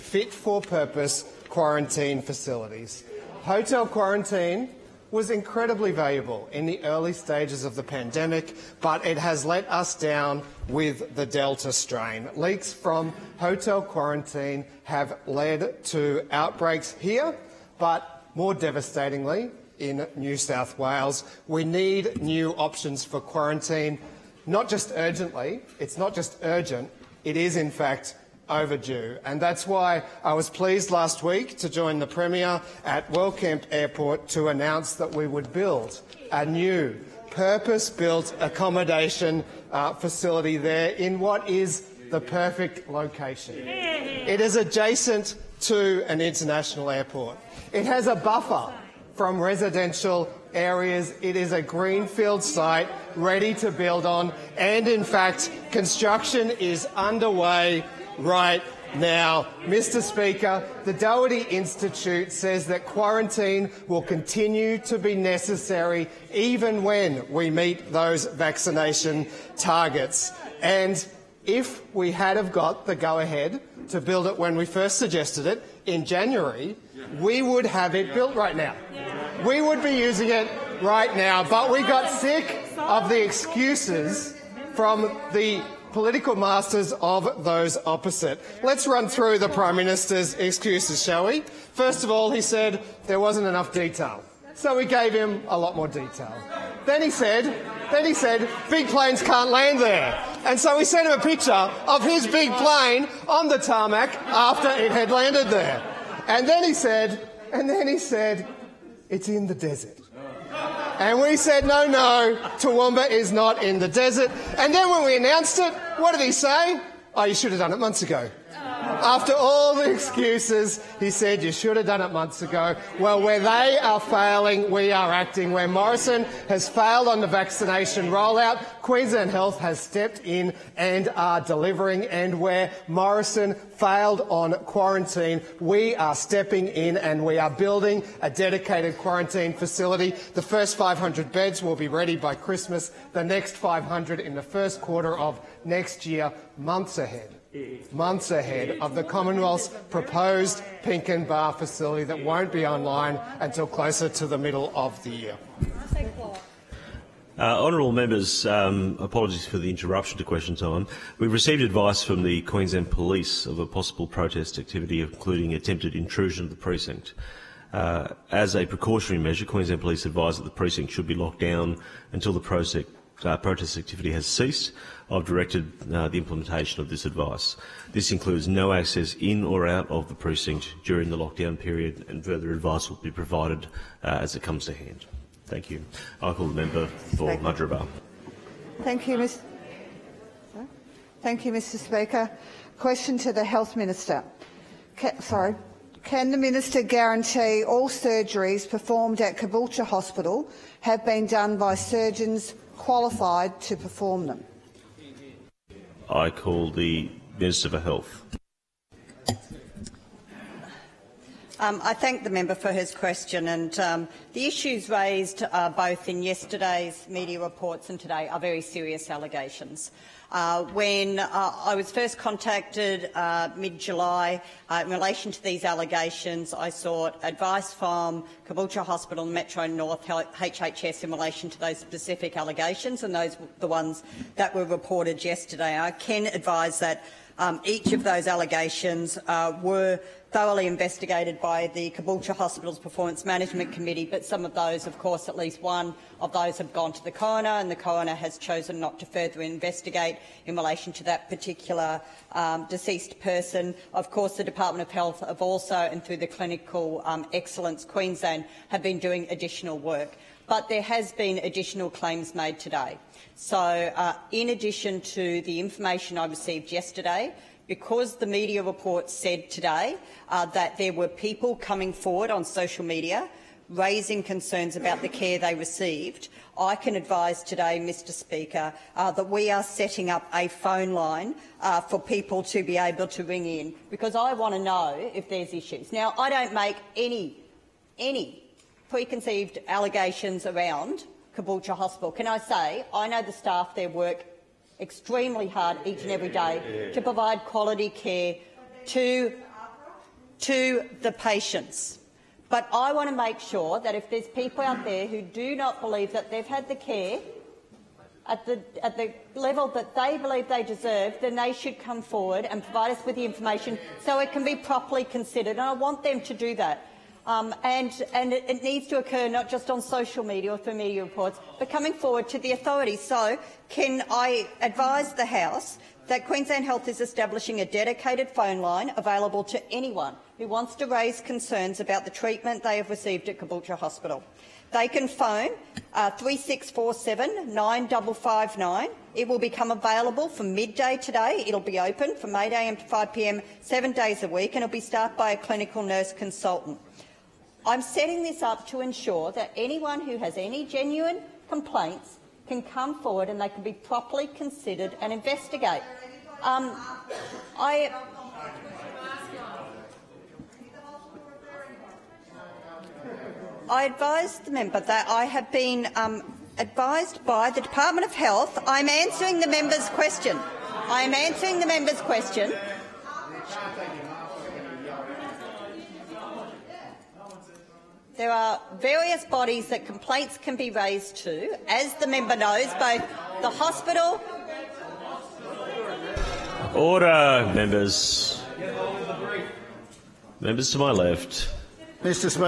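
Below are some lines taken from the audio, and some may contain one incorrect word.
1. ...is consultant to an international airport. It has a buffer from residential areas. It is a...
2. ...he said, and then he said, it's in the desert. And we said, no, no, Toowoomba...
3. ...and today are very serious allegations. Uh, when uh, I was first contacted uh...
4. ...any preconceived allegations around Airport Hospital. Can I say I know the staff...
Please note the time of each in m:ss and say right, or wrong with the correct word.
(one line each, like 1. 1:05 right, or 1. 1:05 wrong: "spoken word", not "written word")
1. 0:44 wrong: "adjacent", not "consultant"
2. 1:46 right
3. 3:37 right
4. 4:47 wrong: "Caboolture", not "Airport".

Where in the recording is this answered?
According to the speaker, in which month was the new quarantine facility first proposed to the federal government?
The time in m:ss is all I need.
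1:16.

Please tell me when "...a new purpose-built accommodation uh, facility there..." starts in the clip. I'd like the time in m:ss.
0:36.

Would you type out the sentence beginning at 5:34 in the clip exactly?
They can phone uh, 3647 9559.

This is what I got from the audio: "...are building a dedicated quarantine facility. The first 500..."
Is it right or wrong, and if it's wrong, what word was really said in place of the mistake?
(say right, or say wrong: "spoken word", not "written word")
right.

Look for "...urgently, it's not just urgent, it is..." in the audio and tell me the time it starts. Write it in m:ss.
0:24.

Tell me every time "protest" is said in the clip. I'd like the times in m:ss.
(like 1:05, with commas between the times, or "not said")
2:44, 2:53.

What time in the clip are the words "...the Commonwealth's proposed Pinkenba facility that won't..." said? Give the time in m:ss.
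2:28.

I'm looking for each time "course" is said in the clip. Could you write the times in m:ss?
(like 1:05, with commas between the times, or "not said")
4:04, 4:14.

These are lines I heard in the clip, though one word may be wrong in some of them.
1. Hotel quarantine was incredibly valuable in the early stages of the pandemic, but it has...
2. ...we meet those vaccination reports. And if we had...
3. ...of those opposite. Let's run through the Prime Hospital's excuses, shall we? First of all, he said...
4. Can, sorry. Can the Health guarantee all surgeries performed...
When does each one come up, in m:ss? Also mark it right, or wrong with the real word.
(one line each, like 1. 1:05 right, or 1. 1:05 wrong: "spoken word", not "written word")
1. 0:03 right
2. 1:07 wrong: "targets", not "reports"
3. 1:26 wrong: "Minister", not "Hospital"
4. 3:14 wrong: "Minister", not "Health".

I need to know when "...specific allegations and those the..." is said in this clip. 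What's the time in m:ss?
3:51.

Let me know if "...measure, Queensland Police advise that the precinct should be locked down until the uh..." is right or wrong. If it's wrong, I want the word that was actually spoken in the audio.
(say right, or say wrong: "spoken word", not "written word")
right.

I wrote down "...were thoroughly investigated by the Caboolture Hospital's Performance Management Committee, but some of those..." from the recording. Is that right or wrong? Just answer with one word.
right.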